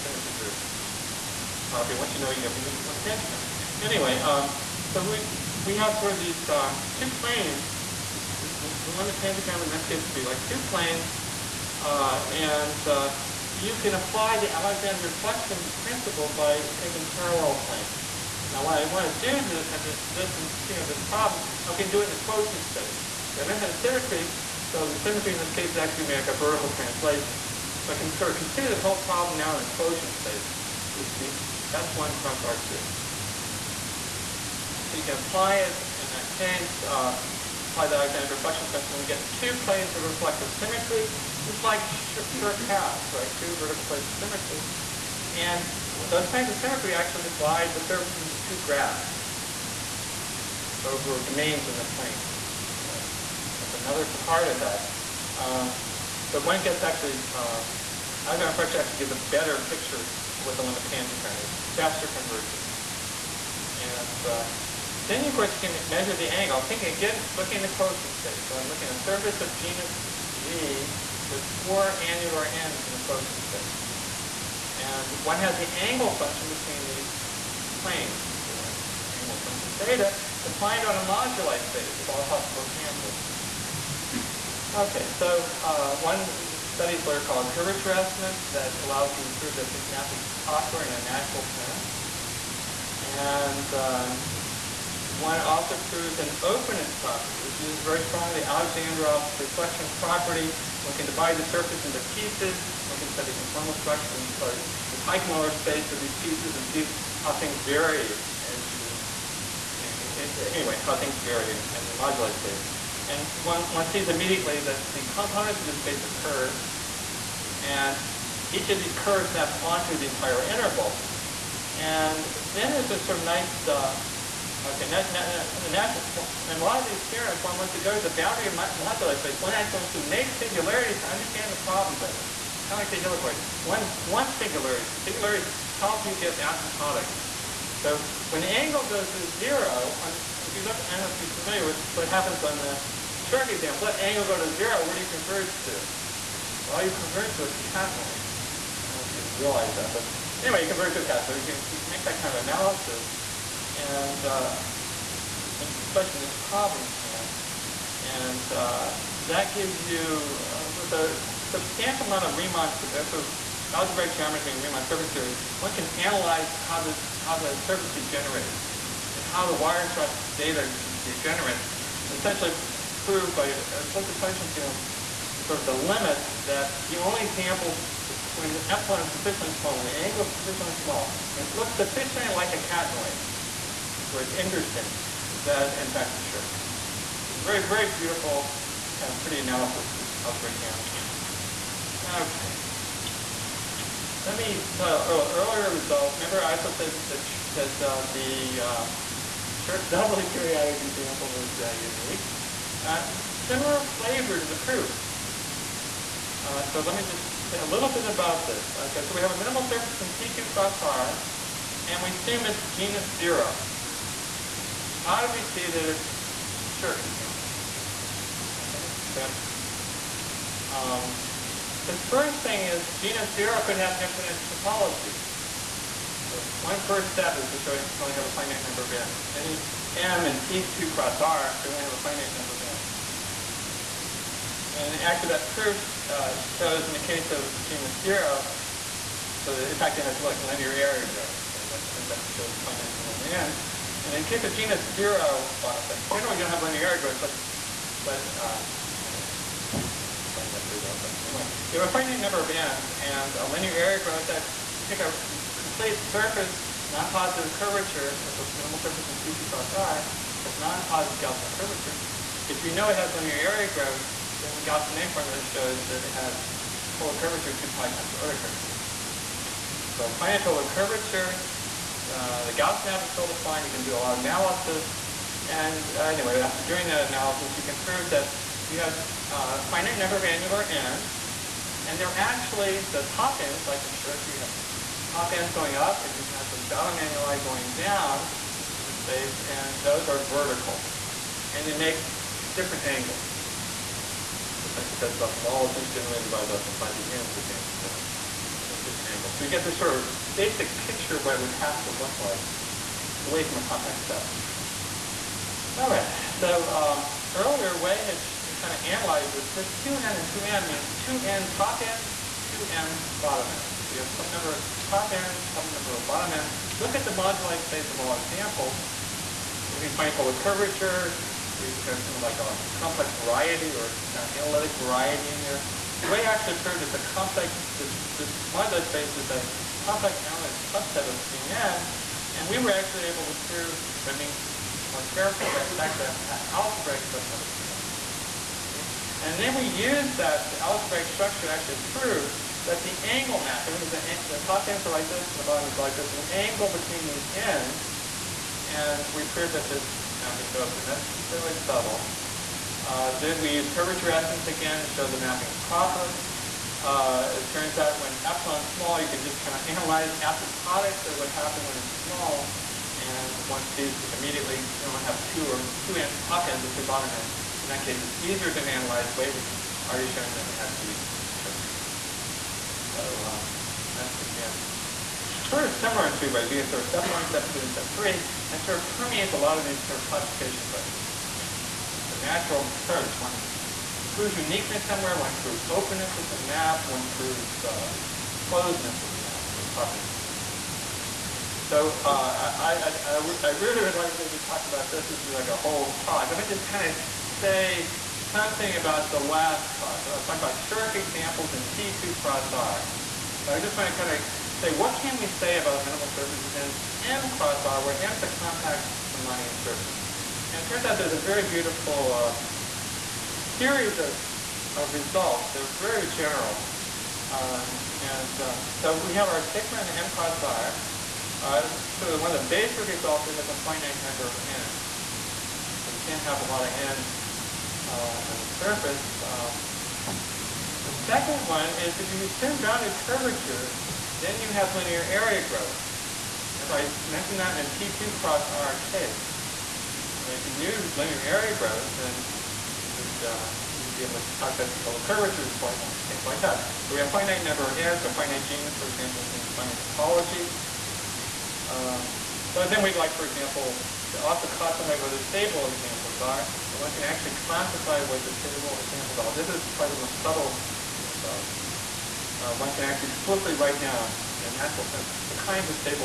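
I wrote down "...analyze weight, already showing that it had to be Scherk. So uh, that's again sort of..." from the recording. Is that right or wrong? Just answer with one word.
right.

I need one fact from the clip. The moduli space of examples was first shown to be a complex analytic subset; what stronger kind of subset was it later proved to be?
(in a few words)
An algebraic subset.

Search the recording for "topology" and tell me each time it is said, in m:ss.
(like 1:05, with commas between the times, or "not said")
3:44, 7:29.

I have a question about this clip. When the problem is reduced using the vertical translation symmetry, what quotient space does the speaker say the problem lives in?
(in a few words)
S1 cross R2.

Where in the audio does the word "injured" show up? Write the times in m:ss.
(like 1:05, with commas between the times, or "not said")
not said.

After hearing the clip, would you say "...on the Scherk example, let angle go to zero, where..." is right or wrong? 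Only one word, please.
right.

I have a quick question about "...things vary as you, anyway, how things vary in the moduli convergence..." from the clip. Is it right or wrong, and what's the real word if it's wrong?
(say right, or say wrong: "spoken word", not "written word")
wrong: "space", not "convergence".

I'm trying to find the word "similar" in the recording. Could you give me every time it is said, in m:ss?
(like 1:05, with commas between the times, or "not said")
3:23, 6:15.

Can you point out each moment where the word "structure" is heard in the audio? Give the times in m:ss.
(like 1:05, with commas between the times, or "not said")
1:43, 5:41.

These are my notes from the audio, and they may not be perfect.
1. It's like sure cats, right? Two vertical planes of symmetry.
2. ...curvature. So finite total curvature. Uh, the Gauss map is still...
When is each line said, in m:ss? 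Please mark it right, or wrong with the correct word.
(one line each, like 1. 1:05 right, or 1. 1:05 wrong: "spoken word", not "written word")
1. 0:41 right
2. 4:28 right.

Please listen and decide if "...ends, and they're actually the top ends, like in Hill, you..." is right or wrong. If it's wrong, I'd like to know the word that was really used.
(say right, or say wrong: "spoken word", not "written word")
wrong: "Scherk", not "Hill".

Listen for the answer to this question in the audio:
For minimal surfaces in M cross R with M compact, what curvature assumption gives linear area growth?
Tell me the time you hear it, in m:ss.
7:12.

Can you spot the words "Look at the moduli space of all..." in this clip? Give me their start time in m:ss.
5:16.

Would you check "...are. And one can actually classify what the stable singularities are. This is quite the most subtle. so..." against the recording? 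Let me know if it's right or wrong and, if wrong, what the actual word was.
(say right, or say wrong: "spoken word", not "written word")
wrong: "examples", not "singularities".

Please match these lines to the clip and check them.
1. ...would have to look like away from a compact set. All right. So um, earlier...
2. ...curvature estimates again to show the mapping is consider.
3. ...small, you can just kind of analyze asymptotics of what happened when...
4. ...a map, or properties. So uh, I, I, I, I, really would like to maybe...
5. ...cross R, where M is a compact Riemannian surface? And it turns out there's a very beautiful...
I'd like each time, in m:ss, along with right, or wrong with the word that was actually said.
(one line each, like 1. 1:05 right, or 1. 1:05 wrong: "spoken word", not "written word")
1. 5:01 right
2. 5:53 wrong: "proper", not "consider"
3. 5:58 right
4. 6:29 right
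5. 6:47 right.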